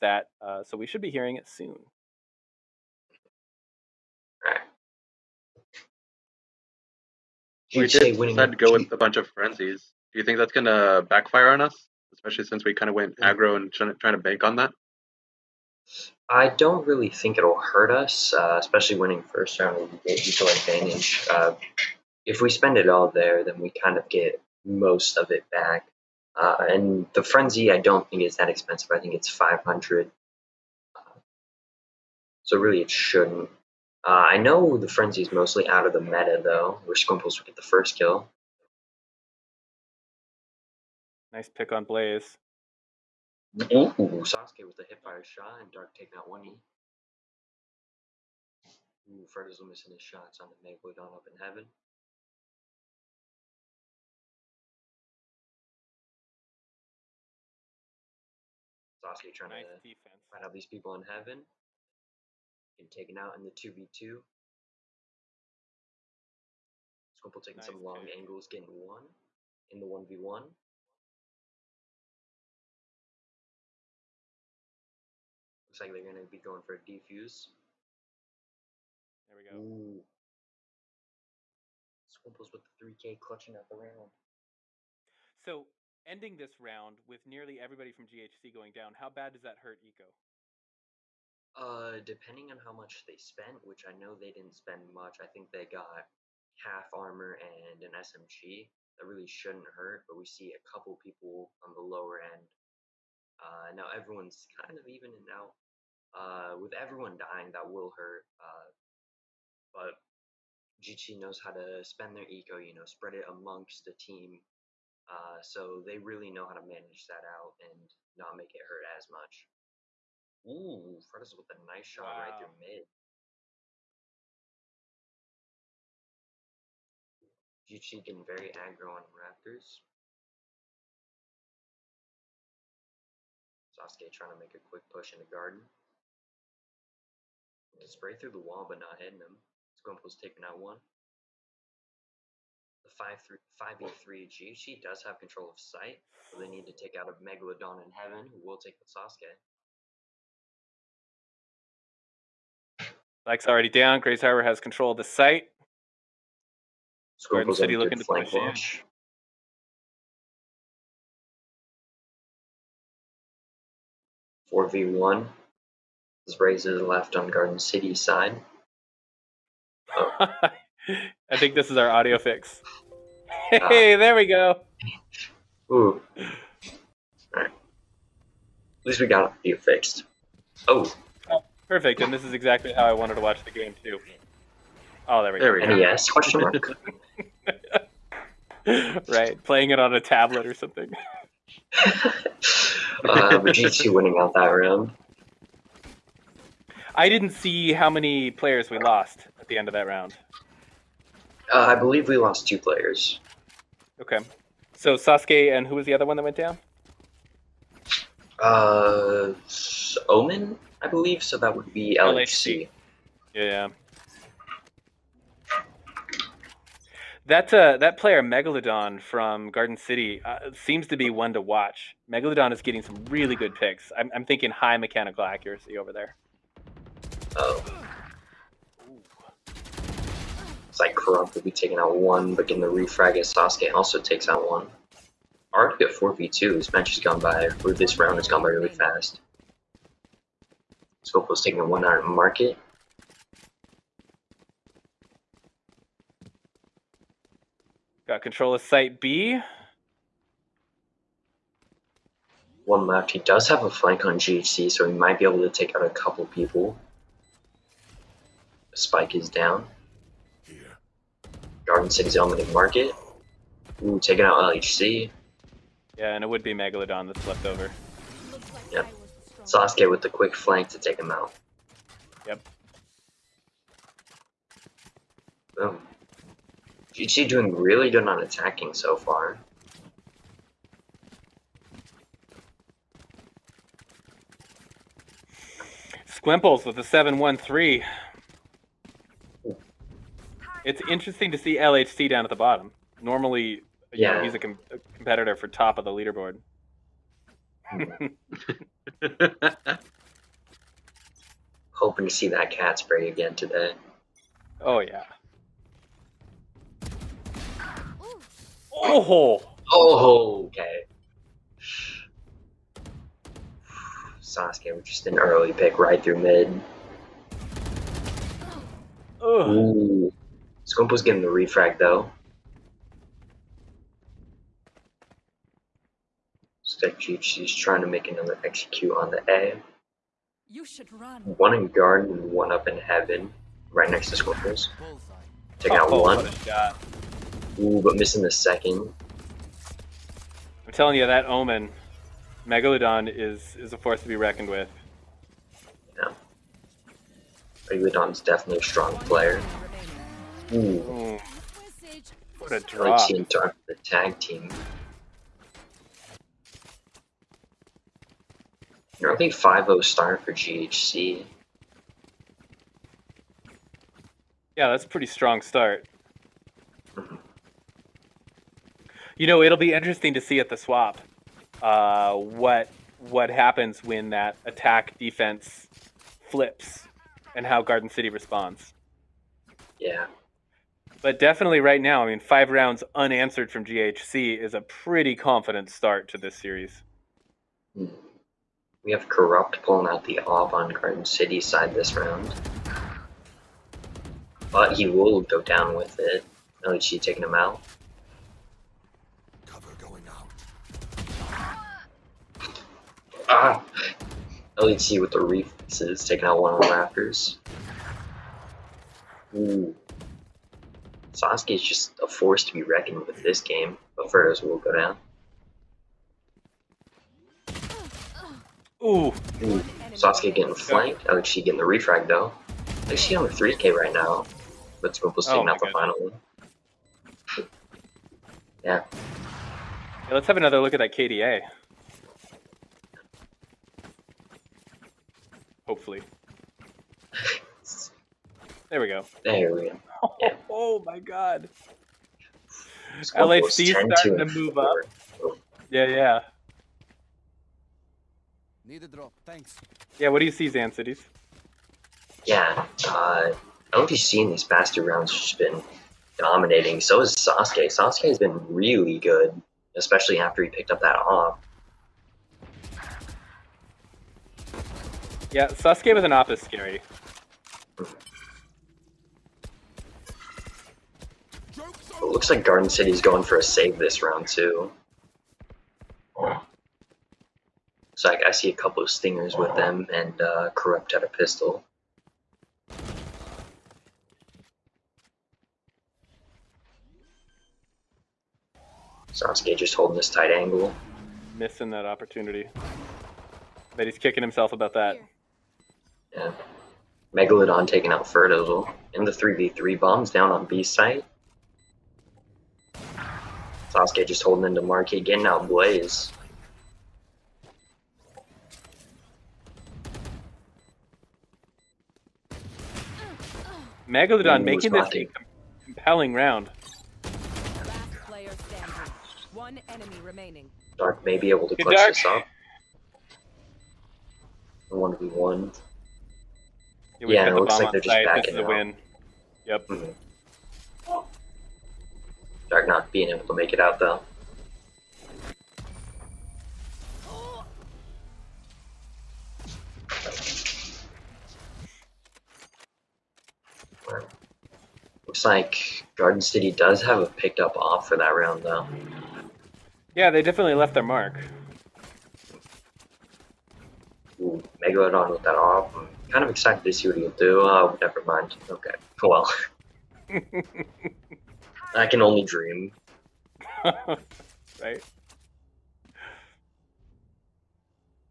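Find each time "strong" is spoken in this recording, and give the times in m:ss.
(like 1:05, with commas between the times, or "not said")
5:48, 6:05.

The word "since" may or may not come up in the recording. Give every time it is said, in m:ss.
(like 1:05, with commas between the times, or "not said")
0:12.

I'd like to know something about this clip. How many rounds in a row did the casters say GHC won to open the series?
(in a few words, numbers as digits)
5.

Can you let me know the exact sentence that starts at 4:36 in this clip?
GT doing really good on attacking so far.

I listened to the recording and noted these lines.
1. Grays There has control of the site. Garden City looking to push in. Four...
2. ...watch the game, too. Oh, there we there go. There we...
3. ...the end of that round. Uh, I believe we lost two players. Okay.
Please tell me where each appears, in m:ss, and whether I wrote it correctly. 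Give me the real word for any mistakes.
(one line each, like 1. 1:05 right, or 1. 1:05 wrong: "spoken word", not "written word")
1. 2:34 wrong: "Harbor", not "There"
2. 3:03 right
3. 3:19 right.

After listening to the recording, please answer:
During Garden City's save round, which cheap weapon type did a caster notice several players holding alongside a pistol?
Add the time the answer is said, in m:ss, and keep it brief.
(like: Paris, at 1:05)
stingers, at 7:58.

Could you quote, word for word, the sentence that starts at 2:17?
To spray through the wall but not hitting him.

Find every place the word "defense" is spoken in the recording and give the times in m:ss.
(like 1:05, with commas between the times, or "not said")
0:59, 6:14.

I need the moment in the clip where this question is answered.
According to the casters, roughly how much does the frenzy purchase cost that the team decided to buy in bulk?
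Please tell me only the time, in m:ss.
0:29.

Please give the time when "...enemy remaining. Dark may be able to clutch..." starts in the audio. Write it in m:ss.
8:39.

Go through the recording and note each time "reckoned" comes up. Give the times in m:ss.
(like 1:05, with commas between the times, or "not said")
5:44, 6:52.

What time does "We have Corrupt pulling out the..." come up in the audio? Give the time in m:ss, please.
6:27.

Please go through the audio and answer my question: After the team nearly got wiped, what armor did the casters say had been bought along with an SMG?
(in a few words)
half armor.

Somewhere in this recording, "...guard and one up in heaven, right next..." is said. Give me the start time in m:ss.
5:31.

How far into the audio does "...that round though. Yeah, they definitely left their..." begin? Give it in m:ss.
9:07.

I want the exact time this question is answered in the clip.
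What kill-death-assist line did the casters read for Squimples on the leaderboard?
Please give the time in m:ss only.
4:46.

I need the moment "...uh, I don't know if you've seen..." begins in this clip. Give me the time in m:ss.
7:32.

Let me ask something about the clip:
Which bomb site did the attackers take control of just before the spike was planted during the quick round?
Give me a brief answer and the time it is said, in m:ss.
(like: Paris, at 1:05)
Site B, at 4:08.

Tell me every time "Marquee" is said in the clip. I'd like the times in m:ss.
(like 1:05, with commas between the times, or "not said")
8:24.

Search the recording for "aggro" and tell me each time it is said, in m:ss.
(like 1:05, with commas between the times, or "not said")
0:13, 2:08.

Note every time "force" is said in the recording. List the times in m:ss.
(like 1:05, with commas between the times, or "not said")
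5:43, 6:52.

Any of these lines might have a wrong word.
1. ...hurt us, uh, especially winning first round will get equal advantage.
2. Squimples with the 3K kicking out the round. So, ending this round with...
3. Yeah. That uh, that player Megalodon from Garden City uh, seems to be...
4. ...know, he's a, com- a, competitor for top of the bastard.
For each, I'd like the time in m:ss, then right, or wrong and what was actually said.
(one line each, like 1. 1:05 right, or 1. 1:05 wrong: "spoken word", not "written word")
1. 0:17 right
2. 1:22 wrong: "clutching", not "kicking"
3. 3:33 right
4. 4:54 wrong: "leaderboard", not "bastard".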